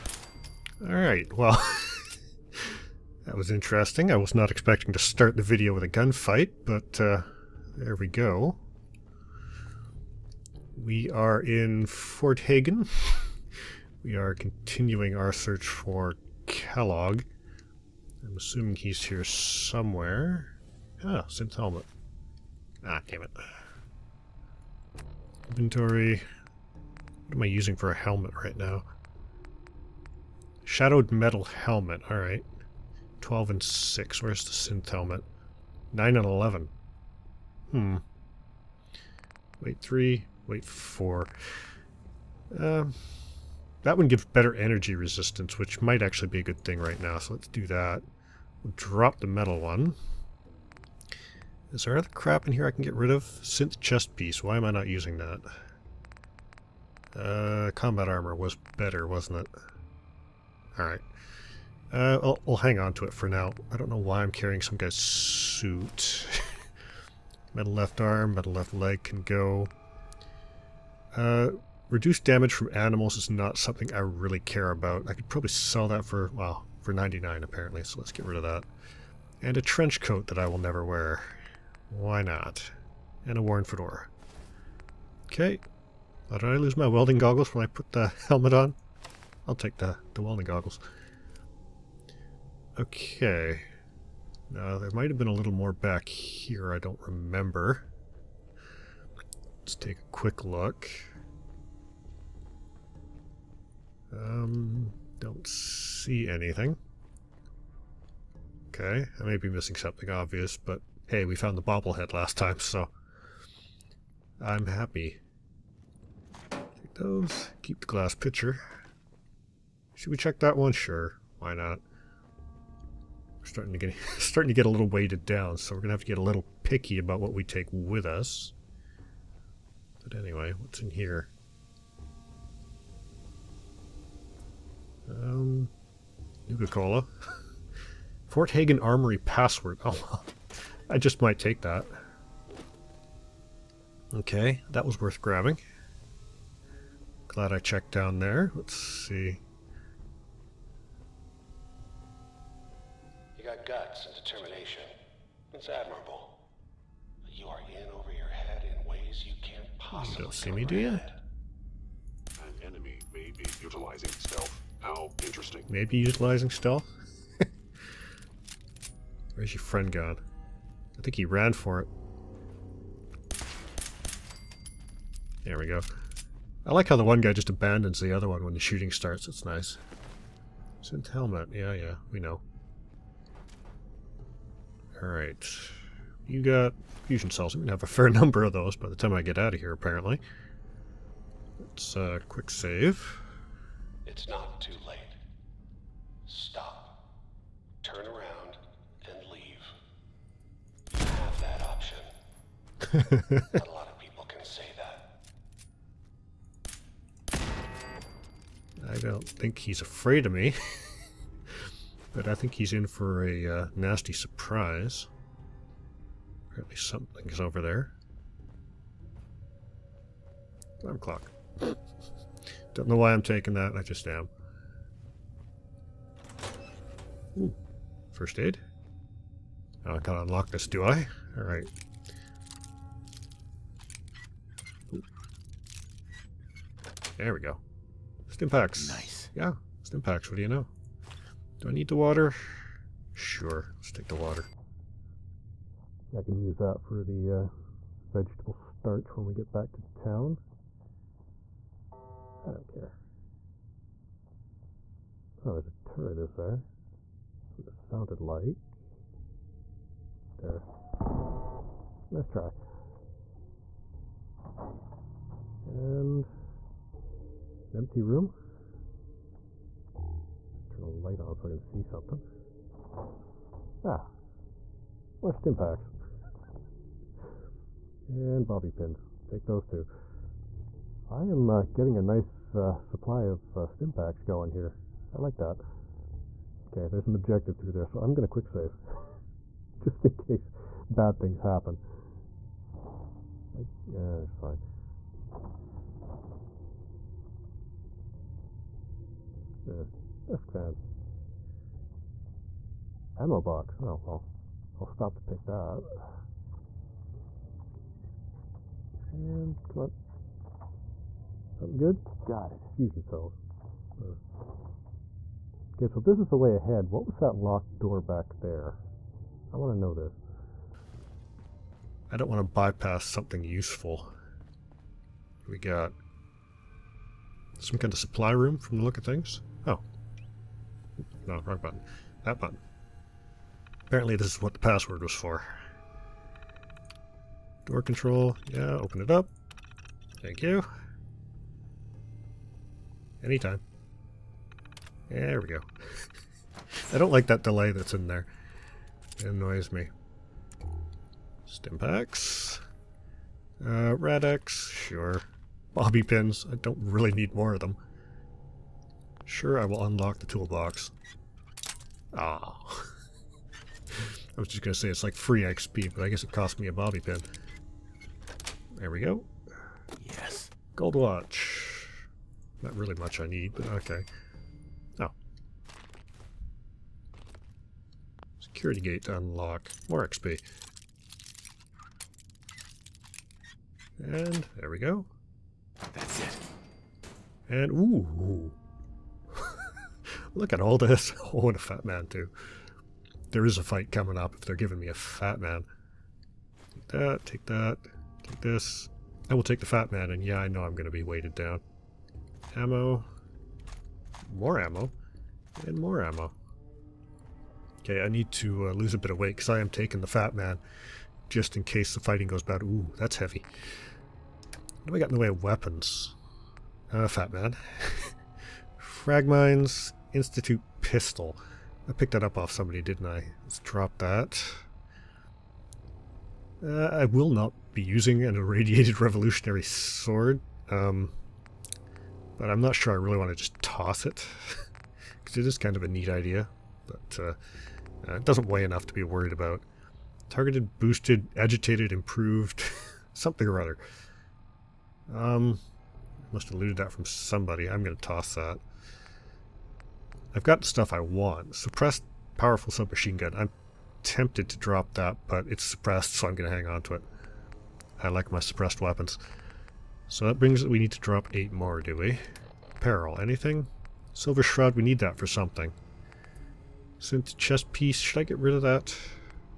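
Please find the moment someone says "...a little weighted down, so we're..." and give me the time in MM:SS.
02:04.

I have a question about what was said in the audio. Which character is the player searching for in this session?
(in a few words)
Kellogg.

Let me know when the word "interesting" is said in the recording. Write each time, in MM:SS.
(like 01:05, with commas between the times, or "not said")
00:03, 02:45.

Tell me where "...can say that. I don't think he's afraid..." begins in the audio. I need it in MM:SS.
03:24.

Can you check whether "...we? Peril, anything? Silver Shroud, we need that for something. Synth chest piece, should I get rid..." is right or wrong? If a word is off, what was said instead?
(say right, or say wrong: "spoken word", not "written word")
right.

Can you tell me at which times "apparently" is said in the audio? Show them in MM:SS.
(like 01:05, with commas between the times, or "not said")
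01:17, 03:09, 03:36, 05:33.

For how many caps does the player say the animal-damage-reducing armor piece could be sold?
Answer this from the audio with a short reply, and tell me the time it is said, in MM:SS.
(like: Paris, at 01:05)
99, at 01:16.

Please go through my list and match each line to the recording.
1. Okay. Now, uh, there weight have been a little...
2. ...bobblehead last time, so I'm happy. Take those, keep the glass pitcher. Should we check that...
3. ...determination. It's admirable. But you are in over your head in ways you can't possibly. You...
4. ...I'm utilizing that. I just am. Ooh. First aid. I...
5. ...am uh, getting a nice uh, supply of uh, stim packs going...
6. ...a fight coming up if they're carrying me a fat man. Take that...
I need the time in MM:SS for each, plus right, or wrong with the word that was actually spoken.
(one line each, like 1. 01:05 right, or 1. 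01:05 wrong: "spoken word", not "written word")
1. 01:32 wrong: "might", not "weight"
2. 01:51 right
3. 02:34 right
4. 03:43 wrong: "taking", not "utilizing"
5. 04:41 right
6. 06:33 wrong: "giving", not "carrying".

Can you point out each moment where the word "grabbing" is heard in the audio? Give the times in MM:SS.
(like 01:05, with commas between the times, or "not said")
02:25.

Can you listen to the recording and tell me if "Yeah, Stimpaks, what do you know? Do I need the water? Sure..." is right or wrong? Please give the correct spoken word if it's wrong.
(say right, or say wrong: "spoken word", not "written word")
right.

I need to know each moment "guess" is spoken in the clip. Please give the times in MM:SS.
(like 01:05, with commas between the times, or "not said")
06:06.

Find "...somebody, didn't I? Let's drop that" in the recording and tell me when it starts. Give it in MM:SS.
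07:02.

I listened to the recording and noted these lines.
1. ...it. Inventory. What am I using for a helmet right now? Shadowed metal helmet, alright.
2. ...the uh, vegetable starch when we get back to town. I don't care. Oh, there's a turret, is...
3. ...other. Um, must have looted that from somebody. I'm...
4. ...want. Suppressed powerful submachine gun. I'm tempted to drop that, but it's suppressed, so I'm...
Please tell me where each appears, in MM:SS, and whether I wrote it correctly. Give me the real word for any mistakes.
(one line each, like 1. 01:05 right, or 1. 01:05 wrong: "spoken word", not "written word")
1. 00:23 right
2. 04:07 right
3. 07:23 right
4. 07:30 right.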